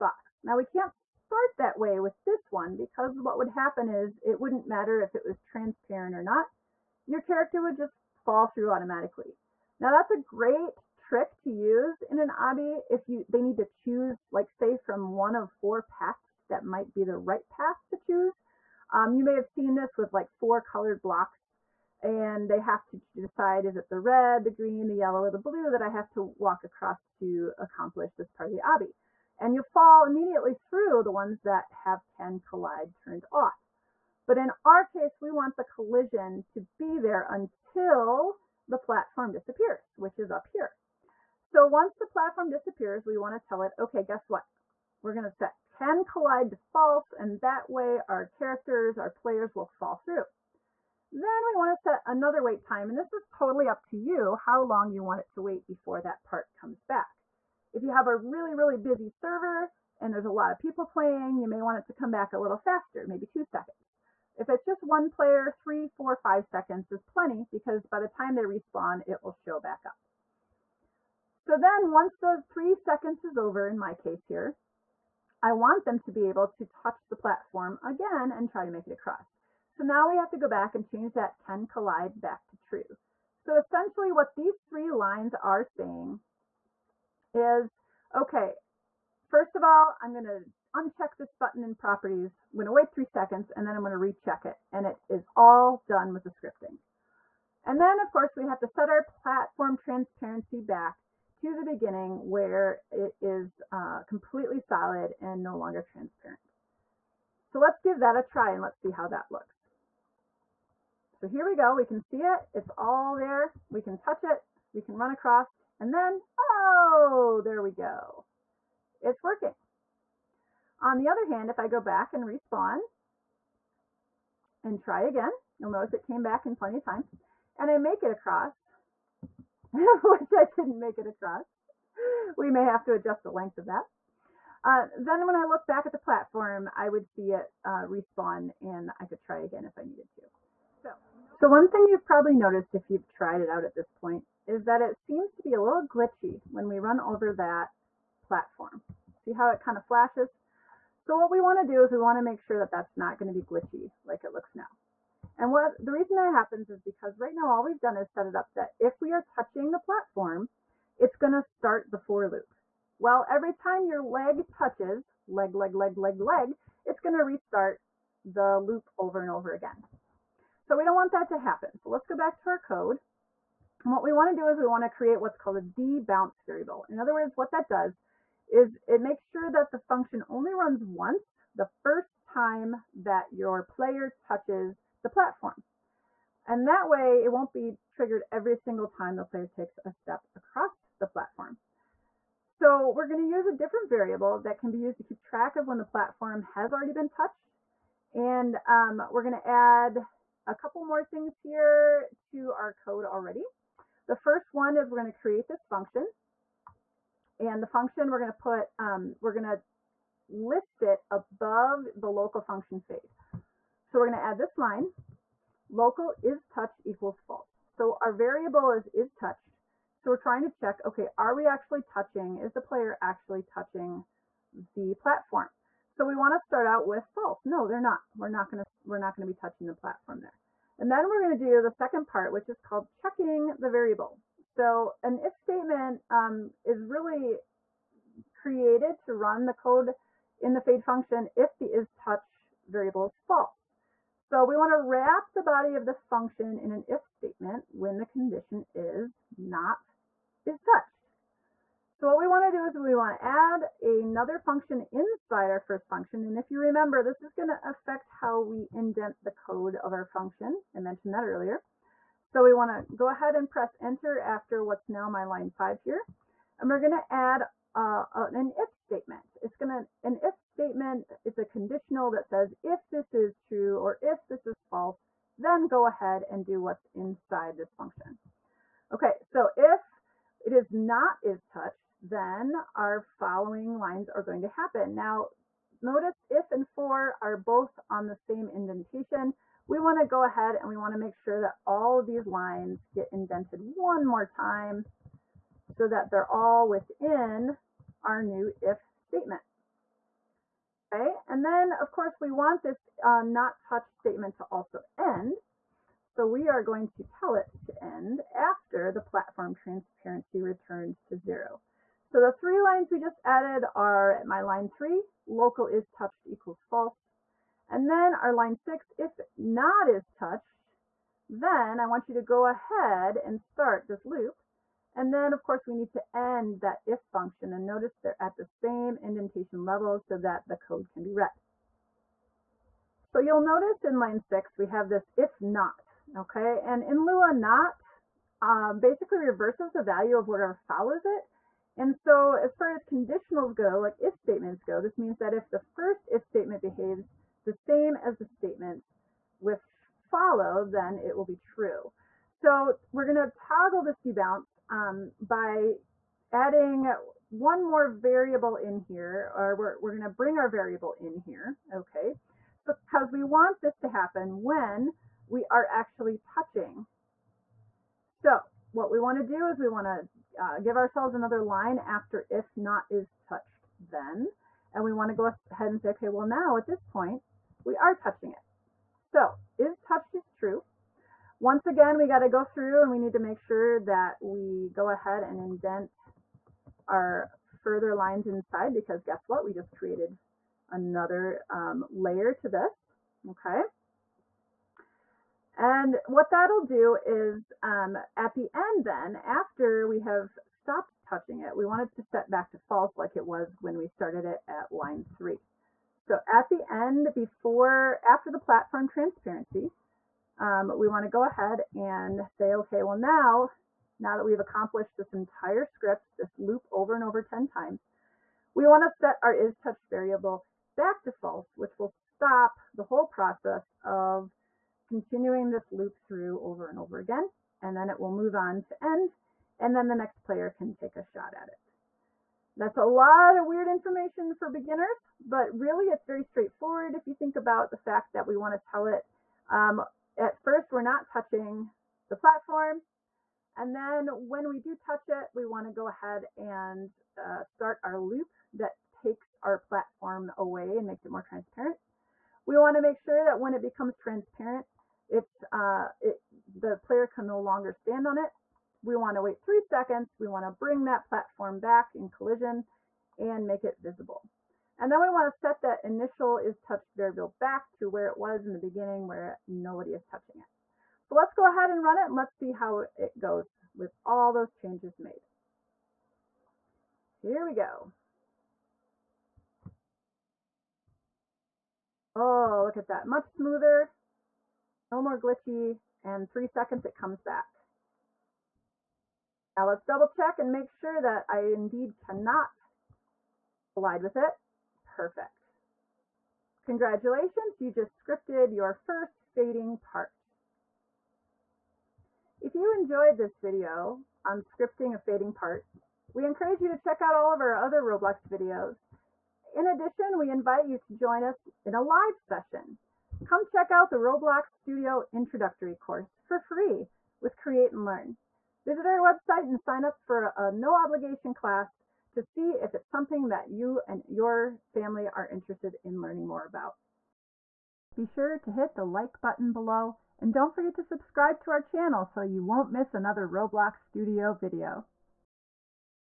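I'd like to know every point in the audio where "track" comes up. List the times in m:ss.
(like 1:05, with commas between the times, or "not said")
3:15.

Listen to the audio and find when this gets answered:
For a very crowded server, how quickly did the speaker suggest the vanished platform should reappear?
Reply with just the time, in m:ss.
1:03.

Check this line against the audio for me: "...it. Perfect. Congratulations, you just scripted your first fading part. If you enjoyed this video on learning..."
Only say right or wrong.
wrong.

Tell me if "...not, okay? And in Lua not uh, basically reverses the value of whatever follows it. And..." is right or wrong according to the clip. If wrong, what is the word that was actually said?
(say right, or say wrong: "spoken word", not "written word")
right.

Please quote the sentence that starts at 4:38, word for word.
Okay, so if it is not is touched, then our following lines are going to happen.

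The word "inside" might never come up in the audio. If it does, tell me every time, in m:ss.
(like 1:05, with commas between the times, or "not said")
4:14, 4:36, 6:28.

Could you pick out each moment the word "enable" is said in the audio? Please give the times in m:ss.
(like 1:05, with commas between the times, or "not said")
not said.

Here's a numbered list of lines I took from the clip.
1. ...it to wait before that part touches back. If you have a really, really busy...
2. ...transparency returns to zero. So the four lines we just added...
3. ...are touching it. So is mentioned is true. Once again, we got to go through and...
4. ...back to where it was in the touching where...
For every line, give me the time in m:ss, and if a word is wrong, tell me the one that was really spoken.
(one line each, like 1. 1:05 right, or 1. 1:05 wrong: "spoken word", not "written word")
1. 0:55 wrong: "comes", not "touches"
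2. 5:09 wrong: "three", not "four"
3. 6:17 wrong: "touched", not "mentioned"
4. 7:47 wrong: "beginning", not "touching".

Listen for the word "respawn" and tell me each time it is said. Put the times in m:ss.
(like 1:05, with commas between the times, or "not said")
1:08, 2:02, 2:17.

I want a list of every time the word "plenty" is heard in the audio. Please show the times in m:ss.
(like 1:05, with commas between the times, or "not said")
1:07, 2:06.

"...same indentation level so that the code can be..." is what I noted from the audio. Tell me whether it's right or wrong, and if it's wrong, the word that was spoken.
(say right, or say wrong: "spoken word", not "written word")
right.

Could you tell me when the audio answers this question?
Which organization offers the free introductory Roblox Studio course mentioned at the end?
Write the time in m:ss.
8:37.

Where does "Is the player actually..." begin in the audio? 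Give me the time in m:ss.
3:42.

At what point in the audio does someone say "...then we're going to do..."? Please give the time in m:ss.
3:50.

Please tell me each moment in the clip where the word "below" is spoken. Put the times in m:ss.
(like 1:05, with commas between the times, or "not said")
8:49.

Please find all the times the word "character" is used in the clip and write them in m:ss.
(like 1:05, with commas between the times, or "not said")
0:07, 0:48.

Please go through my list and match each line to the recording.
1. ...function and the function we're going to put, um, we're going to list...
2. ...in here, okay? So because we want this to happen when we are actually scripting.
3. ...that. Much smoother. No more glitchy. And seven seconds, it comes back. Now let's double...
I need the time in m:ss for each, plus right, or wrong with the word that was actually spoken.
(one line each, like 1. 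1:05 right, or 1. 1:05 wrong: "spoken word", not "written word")
1. 3:25 right
2. 6:00 wrong: "touching", not "scripting"
3. 8:02 wrong: "three", not "seven".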